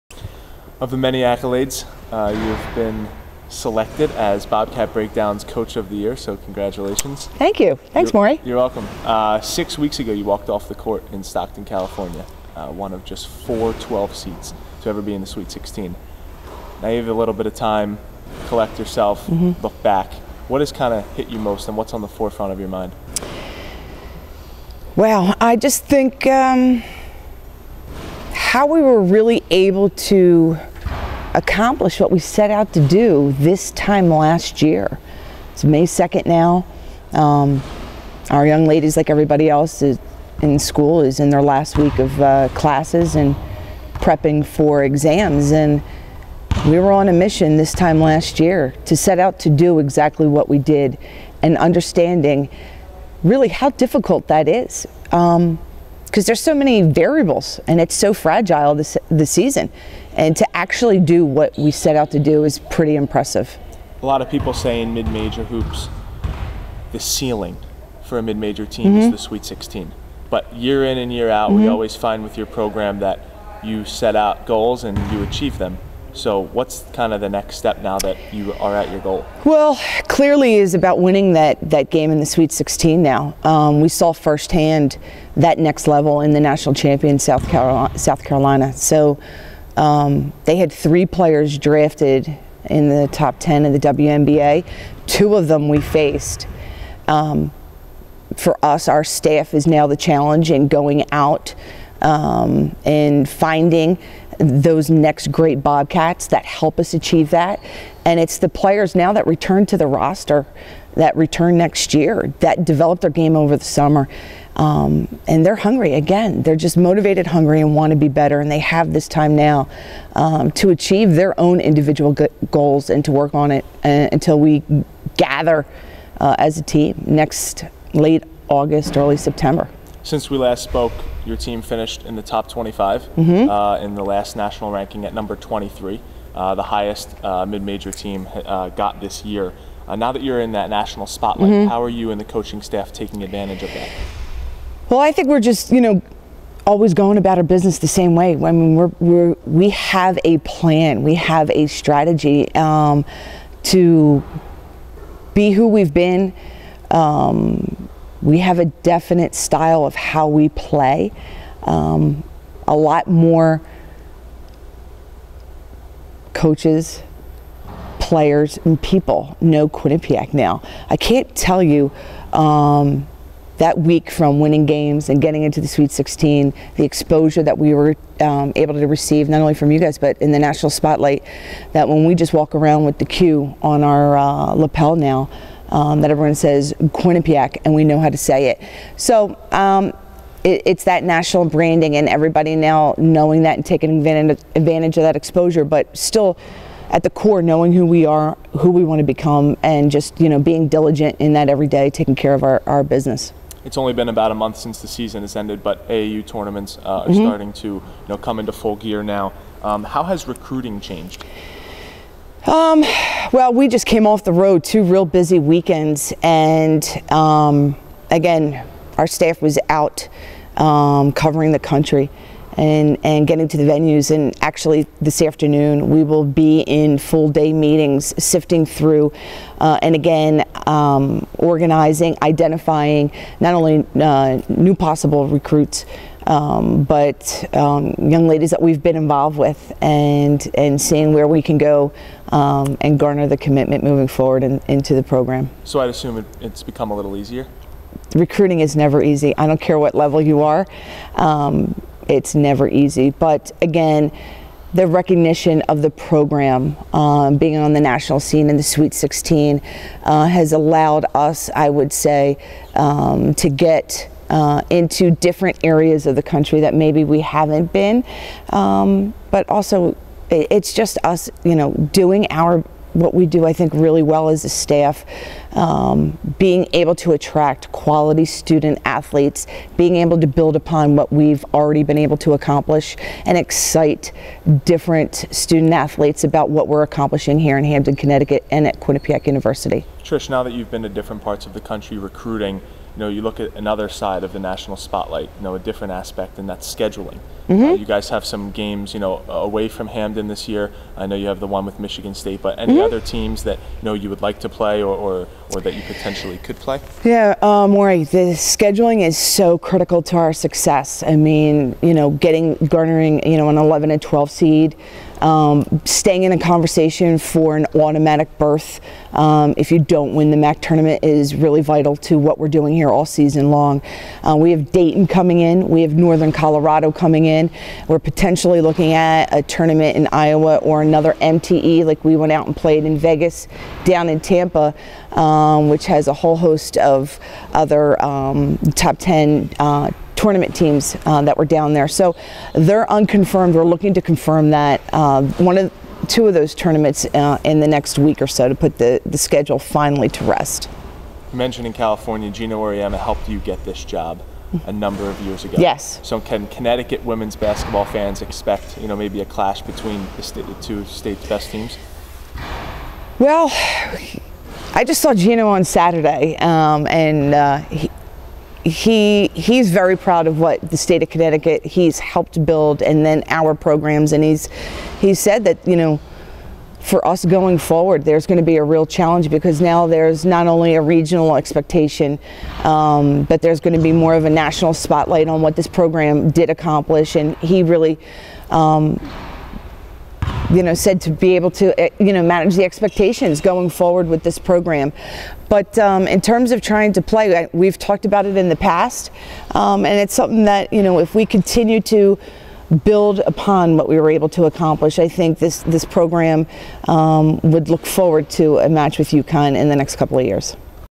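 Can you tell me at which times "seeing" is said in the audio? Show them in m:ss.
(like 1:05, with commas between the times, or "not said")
4:00.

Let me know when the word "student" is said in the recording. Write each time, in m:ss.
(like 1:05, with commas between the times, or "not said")
4:38, 4:45.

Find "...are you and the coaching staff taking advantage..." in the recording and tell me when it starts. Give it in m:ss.
2:21.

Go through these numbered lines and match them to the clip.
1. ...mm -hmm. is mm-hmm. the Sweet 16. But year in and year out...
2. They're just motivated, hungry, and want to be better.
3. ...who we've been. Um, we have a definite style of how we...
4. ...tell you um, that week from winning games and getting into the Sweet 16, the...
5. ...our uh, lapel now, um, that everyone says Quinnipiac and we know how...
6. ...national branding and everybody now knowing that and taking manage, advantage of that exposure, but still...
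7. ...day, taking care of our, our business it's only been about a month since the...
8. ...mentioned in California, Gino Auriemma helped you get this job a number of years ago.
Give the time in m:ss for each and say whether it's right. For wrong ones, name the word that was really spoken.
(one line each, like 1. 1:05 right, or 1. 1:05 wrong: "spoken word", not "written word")
1. 1:08 right
2. 1:56 right
3. 2:35 right
4. 2:51 right
5. 3:03 right
6. 3:11 wrong: "advantage", not "manage"
7. 3:21 right
8. 5:51 right.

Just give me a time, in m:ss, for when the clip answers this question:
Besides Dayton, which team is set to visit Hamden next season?
5:25.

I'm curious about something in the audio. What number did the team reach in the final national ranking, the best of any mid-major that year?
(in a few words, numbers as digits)
23.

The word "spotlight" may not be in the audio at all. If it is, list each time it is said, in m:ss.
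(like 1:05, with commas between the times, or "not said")
2:21, 3:00, 4:54, 6:24.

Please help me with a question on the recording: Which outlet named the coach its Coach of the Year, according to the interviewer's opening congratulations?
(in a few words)
Bobcat Breakdown.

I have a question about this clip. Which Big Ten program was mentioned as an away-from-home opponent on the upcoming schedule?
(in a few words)
Michigan State.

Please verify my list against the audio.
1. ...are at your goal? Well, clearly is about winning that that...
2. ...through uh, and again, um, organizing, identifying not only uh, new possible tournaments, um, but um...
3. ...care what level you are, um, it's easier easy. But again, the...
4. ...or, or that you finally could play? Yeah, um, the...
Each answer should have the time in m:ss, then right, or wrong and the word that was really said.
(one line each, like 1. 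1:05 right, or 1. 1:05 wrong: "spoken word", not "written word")
1. 1:18 right
2. 3:48 wrong: "recruits", not "tournaments"
3. 4:09 wrong: "never", not "easier"
4. 5:04 wrong: "potentially", not "finally".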